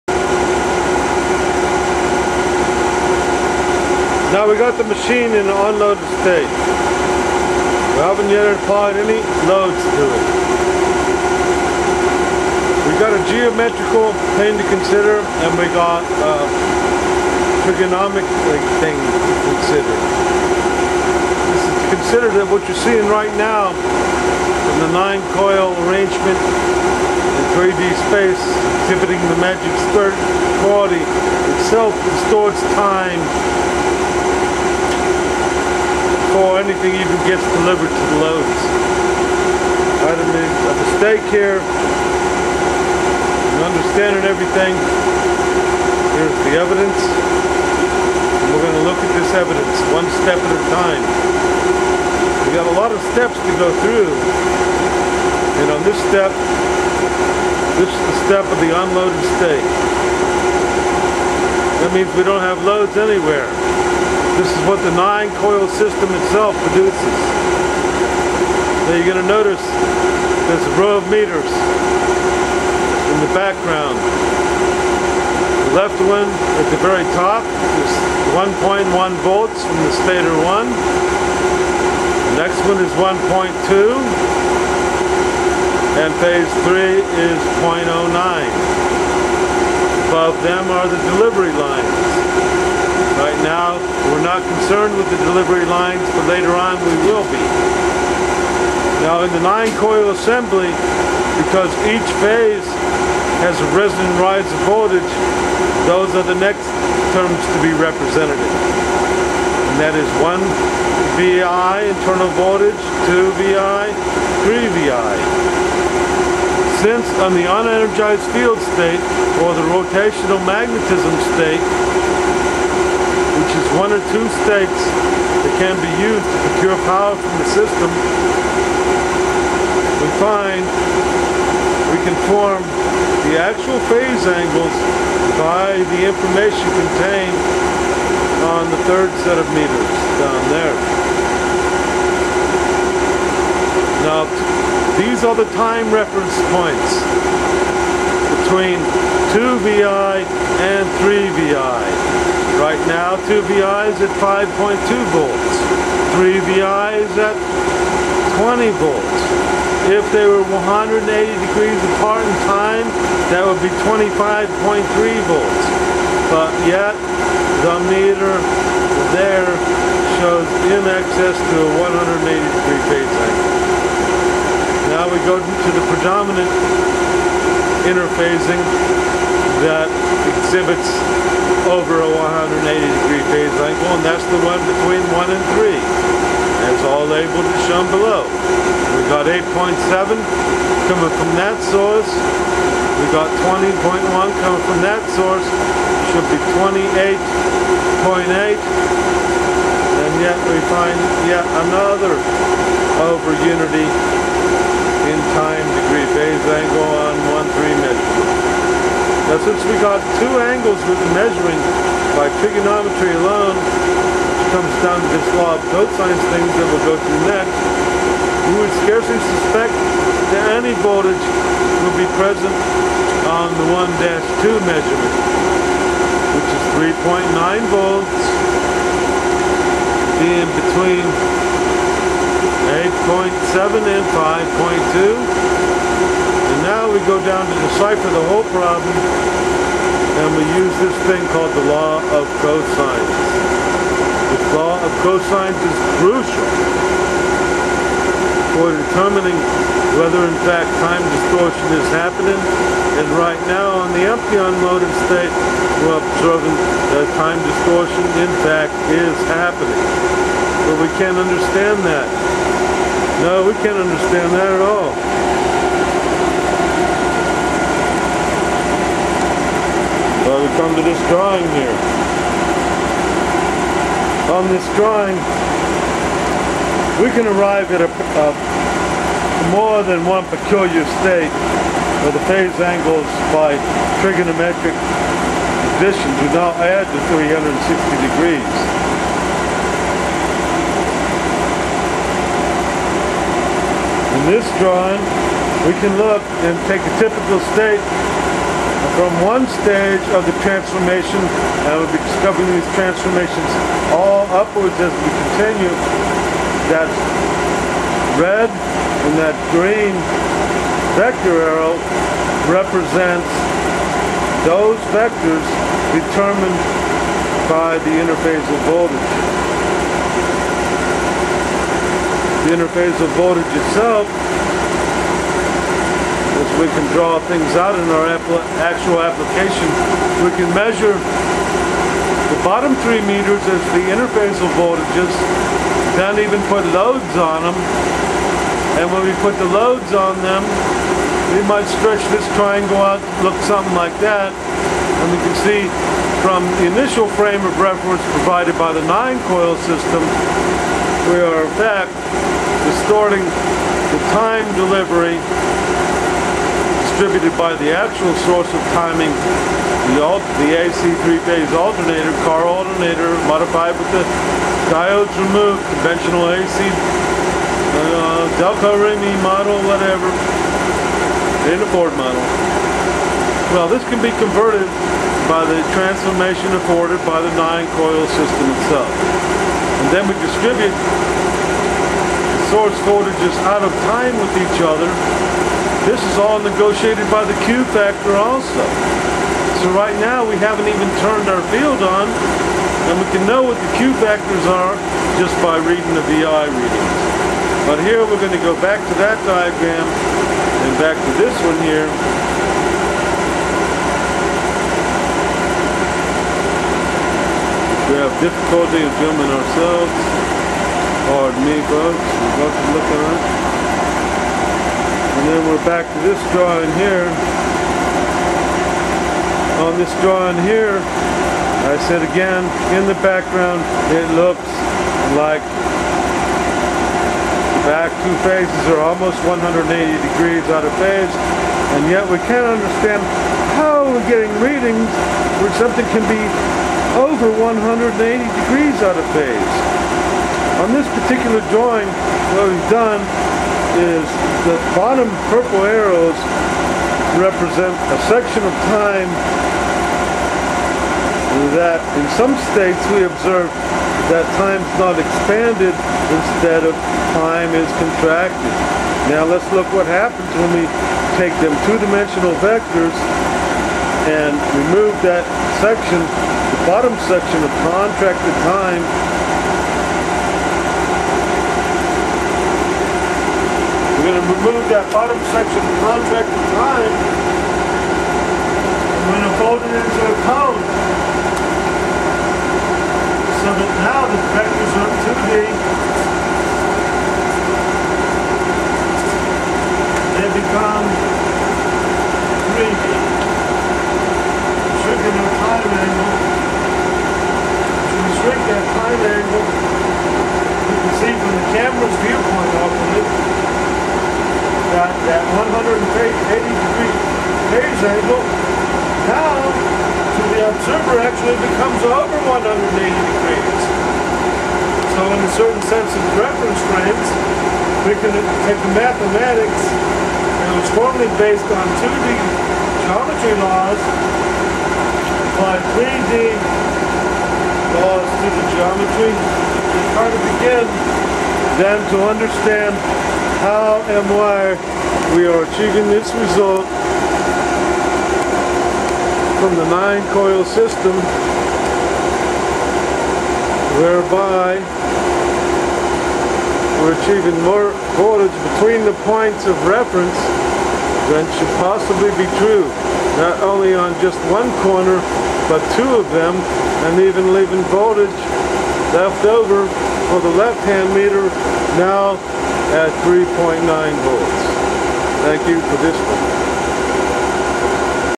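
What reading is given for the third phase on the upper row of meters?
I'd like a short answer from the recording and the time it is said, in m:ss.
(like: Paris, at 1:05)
0.09, at 1:27.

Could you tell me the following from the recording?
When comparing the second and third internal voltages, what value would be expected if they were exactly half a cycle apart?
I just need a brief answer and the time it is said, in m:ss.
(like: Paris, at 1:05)
25.3 volts, at 2:43.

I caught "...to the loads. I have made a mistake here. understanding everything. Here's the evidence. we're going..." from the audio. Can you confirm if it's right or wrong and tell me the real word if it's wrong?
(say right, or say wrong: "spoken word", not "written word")
right.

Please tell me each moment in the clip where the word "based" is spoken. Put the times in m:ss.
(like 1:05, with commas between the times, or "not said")
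8:41.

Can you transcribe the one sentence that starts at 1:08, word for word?
Now you're going to notice there's a row of meters in the background.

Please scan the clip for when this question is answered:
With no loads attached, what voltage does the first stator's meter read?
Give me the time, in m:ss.
1:18.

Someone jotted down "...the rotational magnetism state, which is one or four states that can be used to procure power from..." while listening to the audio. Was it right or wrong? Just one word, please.
wrong.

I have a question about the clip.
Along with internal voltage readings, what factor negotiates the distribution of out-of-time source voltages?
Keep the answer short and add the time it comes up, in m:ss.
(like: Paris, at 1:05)
Q factor, at 6:27.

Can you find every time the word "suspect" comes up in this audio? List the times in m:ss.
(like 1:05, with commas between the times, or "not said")
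3:39.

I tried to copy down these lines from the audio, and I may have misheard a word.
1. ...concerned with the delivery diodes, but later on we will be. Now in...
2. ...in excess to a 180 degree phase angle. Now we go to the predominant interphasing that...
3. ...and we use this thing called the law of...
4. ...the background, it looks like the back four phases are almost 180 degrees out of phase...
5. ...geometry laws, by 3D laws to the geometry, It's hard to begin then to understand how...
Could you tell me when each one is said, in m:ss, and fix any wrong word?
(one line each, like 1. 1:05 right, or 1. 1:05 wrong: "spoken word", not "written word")
1. 1:34 wrong: "lines", not "diodes"
2. 2:50 right
3. 4:00 right
4. 7:02 wrong: "two", not "four"
5. 8:42 right.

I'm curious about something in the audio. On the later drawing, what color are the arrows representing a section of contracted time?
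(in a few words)
purple.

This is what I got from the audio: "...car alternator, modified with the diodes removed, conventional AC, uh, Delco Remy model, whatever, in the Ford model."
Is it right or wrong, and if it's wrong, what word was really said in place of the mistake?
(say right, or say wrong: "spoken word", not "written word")
right.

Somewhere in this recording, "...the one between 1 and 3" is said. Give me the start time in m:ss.
3:04.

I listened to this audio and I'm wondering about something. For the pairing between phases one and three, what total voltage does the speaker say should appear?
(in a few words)
28.8.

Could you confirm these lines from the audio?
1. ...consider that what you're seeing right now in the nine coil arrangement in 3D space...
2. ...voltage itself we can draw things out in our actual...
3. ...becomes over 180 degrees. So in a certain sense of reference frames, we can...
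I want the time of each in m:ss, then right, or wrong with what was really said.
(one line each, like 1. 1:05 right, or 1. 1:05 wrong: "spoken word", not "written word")
1. 0:21 right
2. 5:23 right
3. 8:31 right.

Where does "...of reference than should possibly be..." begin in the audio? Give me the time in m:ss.
9:09.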